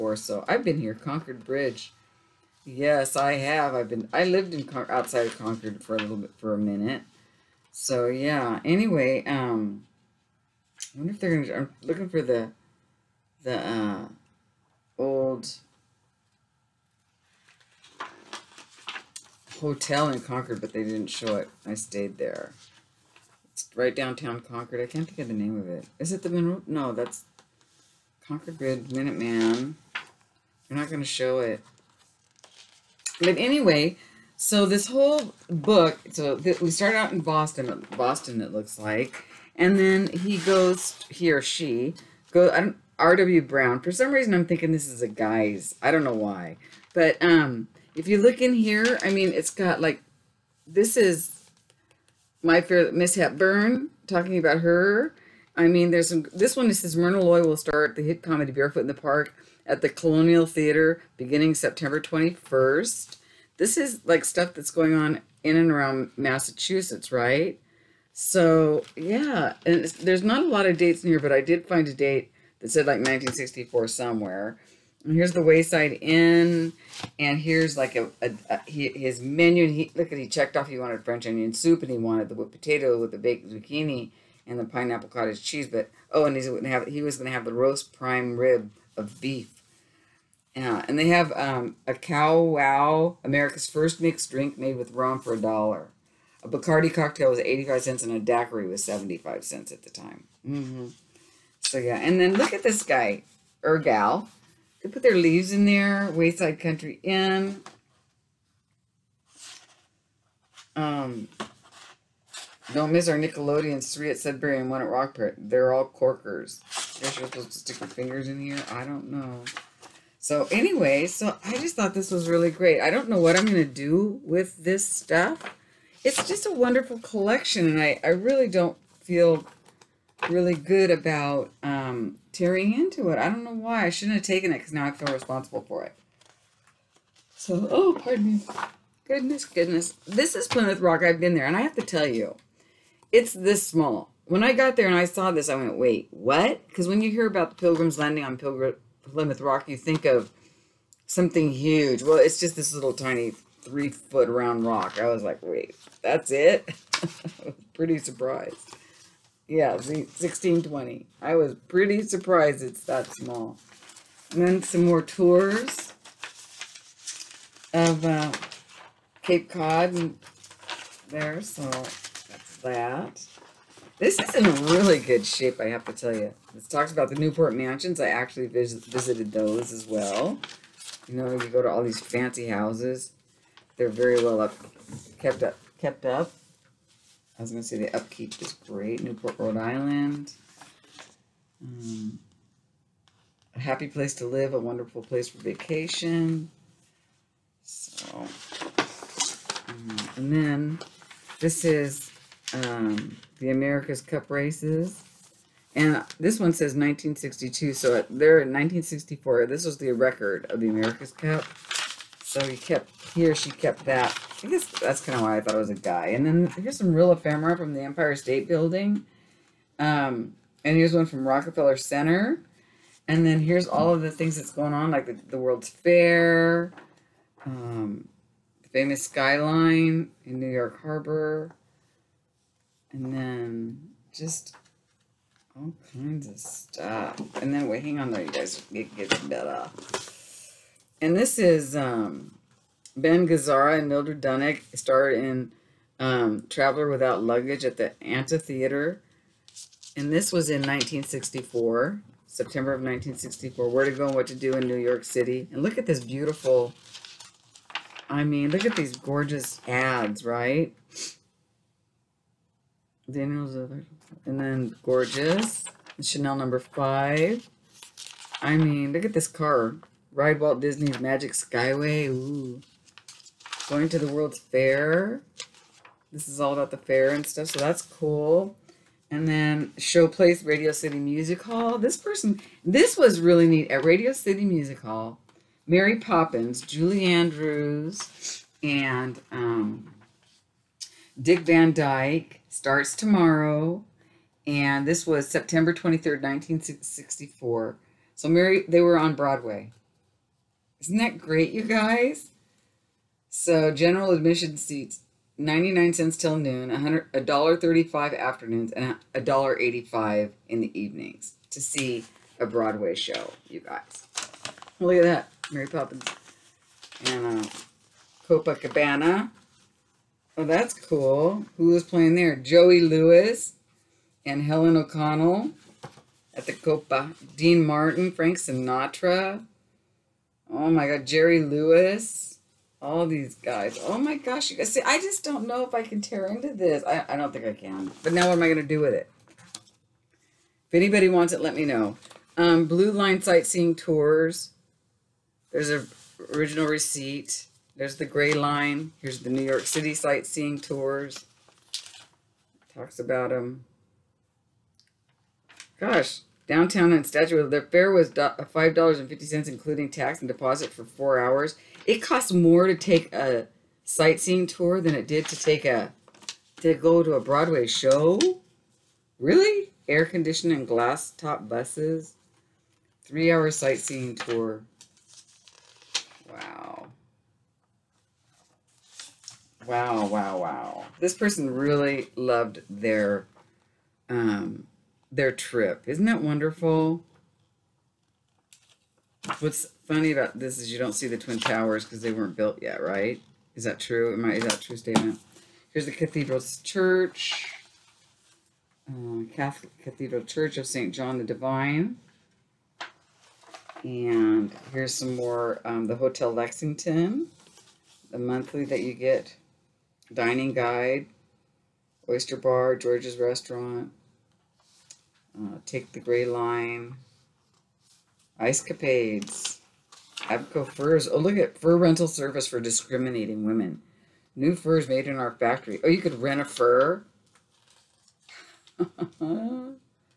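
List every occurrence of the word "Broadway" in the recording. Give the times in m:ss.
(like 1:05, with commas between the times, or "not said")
4:59, 5:12, 6:07.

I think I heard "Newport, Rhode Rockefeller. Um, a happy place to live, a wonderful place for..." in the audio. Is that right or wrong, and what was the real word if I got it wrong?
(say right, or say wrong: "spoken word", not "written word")
wrong: "Island", not "Rockefeller".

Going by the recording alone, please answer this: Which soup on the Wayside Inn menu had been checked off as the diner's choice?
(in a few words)
French onion soup.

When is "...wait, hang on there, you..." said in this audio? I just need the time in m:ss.
3:57.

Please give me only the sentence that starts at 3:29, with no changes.
This was the record of the America's Cup.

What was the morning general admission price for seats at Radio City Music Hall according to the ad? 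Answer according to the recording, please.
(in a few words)
99 cents.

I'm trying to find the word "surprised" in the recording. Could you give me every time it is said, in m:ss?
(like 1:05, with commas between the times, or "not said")
2:37, 2:42.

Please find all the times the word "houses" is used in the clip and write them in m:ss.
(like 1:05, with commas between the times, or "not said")
3:02.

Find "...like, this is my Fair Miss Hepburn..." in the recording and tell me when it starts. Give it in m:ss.
0:49.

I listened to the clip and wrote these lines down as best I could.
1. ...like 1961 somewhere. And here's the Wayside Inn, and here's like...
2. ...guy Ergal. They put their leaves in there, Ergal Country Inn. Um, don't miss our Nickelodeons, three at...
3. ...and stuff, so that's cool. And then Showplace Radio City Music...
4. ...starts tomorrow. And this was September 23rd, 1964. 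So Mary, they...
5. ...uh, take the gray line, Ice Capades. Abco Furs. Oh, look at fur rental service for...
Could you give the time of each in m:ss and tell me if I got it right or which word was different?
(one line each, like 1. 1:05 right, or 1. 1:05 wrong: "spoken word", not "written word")
1. 1:12 wrong: "1964", not "1961"
2. 1:42 wrong: "Wayside", not "Ergal"
3. 4:37 right
4. 4:52 right
5. 6:55 right.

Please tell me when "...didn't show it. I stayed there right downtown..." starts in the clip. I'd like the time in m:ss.
0:20.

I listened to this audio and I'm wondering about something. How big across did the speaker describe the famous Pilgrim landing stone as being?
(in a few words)
3 foot.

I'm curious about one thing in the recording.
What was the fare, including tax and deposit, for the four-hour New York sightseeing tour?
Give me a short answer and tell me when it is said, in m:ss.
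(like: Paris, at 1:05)
$5.50, at 5:58.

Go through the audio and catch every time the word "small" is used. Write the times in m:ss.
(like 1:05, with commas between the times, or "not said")
2:23, 2:43.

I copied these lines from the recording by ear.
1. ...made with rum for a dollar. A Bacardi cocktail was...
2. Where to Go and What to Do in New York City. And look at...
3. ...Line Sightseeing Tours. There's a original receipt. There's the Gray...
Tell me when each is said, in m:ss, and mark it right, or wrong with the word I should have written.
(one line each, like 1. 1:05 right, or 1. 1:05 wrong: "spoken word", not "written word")
1. 1:34 right
2. 4:13 right
3. 5:42 right.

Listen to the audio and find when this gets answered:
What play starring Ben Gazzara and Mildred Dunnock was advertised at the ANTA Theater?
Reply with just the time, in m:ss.
4:06.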